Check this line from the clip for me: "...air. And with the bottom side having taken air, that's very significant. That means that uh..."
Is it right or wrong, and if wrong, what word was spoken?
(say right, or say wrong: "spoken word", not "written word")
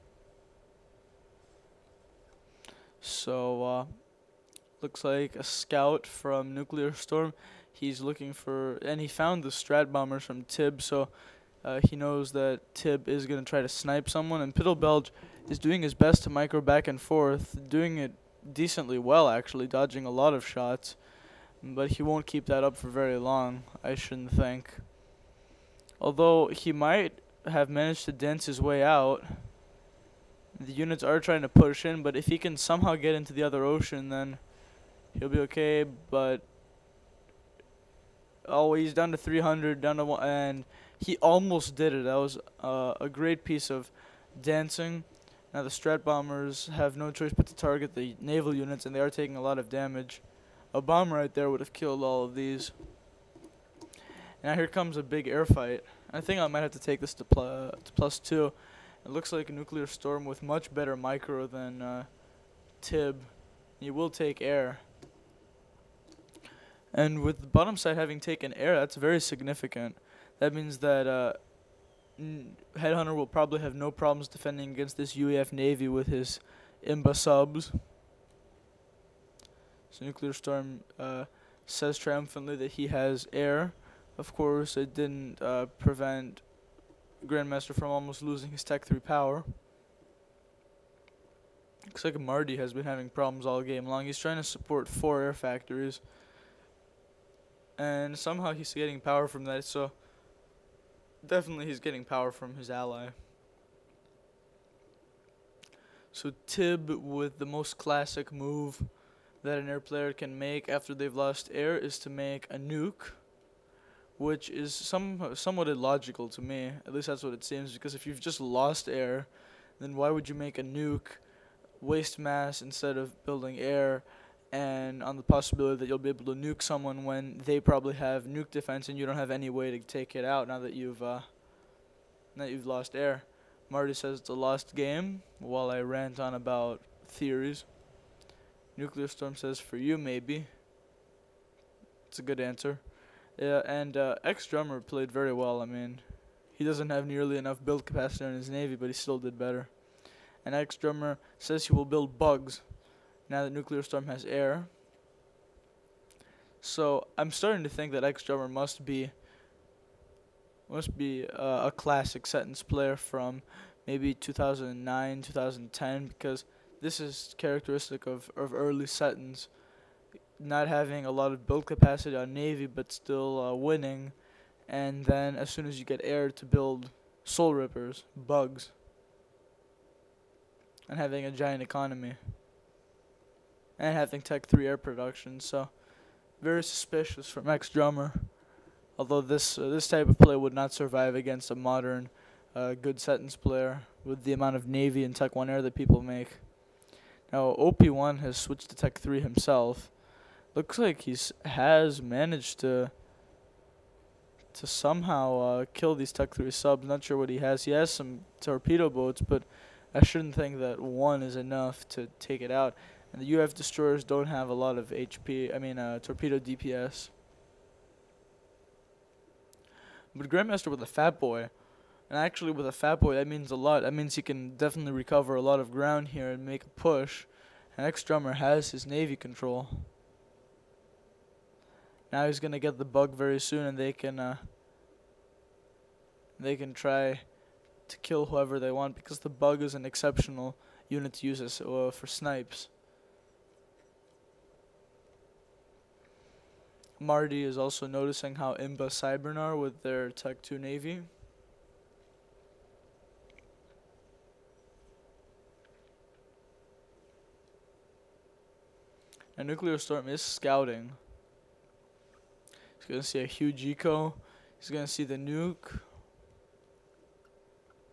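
right.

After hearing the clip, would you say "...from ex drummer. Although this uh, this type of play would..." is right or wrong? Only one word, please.
right.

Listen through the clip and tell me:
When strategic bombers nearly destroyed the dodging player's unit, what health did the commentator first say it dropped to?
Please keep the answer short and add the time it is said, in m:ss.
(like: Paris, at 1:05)
300, at 0:39.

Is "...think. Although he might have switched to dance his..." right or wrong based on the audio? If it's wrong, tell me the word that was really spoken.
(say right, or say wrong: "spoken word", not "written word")
wrong: "managed", not "switched".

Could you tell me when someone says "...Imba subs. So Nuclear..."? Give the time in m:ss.
1:16.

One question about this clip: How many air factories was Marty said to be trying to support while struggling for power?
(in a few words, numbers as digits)
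4.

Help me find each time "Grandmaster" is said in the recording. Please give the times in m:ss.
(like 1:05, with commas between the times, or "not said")
1:27, 3:40.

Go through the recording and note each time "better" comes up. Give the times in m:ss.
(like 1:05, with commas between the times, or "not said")
1:00, 2:29.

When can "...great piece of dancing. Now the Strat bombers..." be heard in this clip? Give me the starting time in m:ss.
0:43.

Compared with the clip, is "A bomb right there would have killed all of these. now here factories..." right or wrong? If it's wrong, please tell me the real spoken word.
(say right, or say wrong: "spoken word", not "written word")
wrong: "comes", not "factories".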